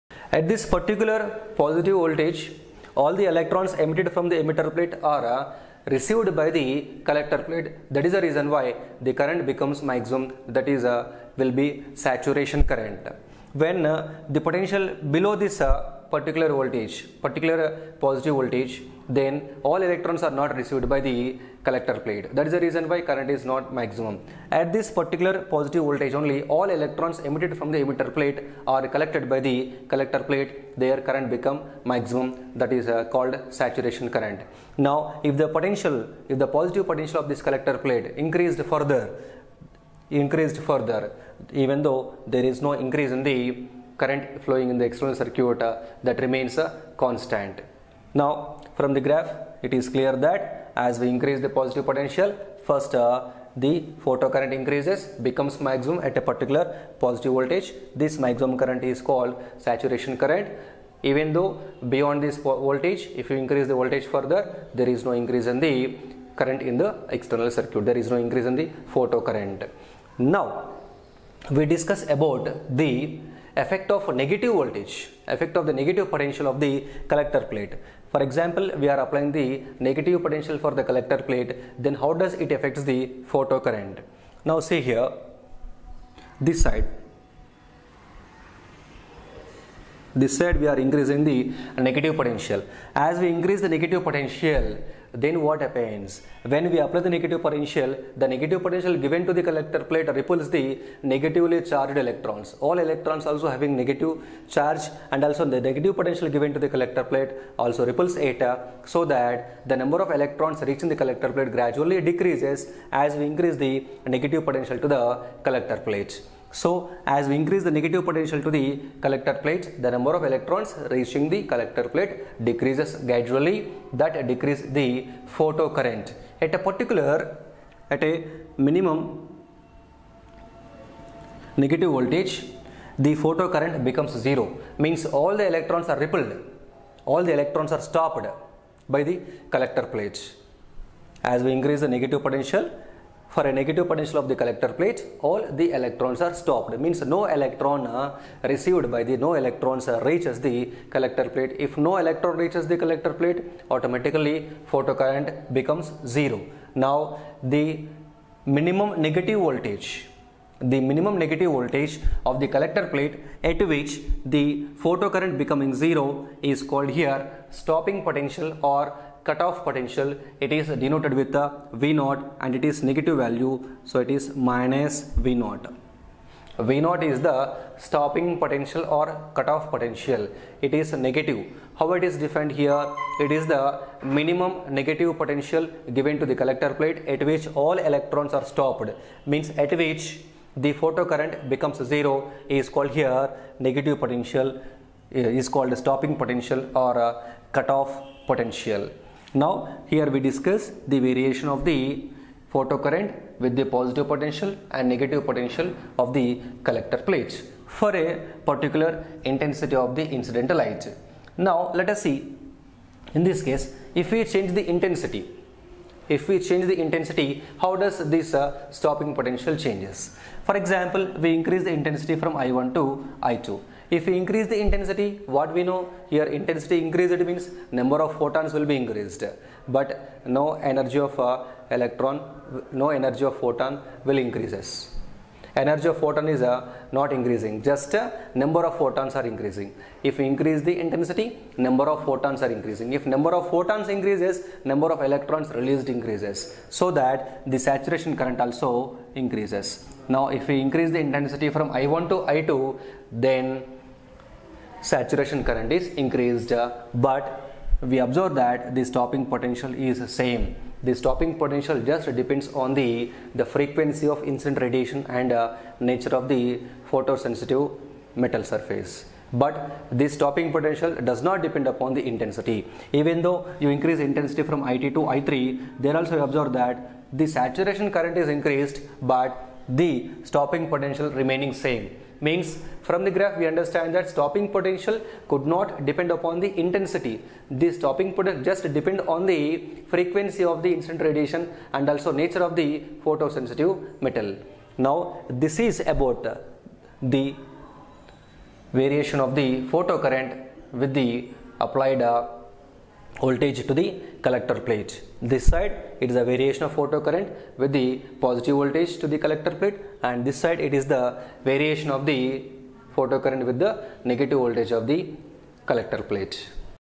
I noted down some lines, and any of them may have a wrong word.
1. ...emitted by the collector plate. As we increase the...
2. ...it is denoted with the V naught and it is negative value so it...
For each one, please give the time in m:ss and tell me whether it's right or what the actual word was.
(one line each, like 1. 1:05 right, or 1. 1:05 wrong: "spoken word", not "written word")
1. 2:17 wrong: "stopped", not "emitted"
2. 2:50 right.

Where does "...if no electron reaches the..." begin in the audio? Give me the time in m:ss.
2:31.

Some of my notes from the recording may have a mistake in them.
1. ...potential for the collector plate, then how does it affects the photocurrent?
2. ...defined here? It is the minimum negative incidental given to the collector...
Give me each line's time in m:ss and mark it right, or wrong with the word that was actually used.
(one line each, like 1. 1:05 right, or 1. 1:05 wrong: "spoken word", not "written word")
1. 1:20 right
2. 3:02 wrong: "potential", not "incidental".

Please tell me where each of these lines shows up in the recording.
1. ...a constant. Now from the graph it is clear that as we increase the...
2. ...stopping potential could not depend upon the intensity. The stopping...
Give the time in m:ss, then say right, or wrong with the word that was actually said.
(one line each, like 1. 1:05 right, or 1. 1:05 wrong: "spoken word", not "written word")
1. 0:46 right
2. 4:44 right.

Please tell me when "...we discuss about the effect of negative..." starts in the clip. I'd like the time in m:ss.
1:11.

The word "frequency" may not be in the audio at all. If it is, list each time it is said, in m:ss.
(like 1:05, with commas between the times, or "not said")
4:23, 4:49.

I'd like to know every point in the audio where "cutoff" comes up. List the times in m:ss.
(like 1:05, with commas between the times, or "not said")
2:49, 2:59, 3:17.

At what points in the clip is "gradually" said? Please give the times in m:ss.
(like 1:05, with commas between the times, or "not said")
1:51, 2:02.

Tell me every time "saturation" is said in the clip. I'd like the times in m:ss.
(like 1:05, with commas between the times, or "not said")
0:11, 0:33, 0:59, 4:07, 4:14, 4:37.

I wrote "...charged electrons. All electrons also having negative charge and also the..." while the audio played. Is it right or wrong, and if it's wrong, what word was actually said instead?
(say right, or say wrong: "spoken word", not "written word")
right.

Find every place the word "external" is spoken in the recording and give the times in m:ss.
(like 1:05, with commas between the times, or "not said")
0:44, 1:07.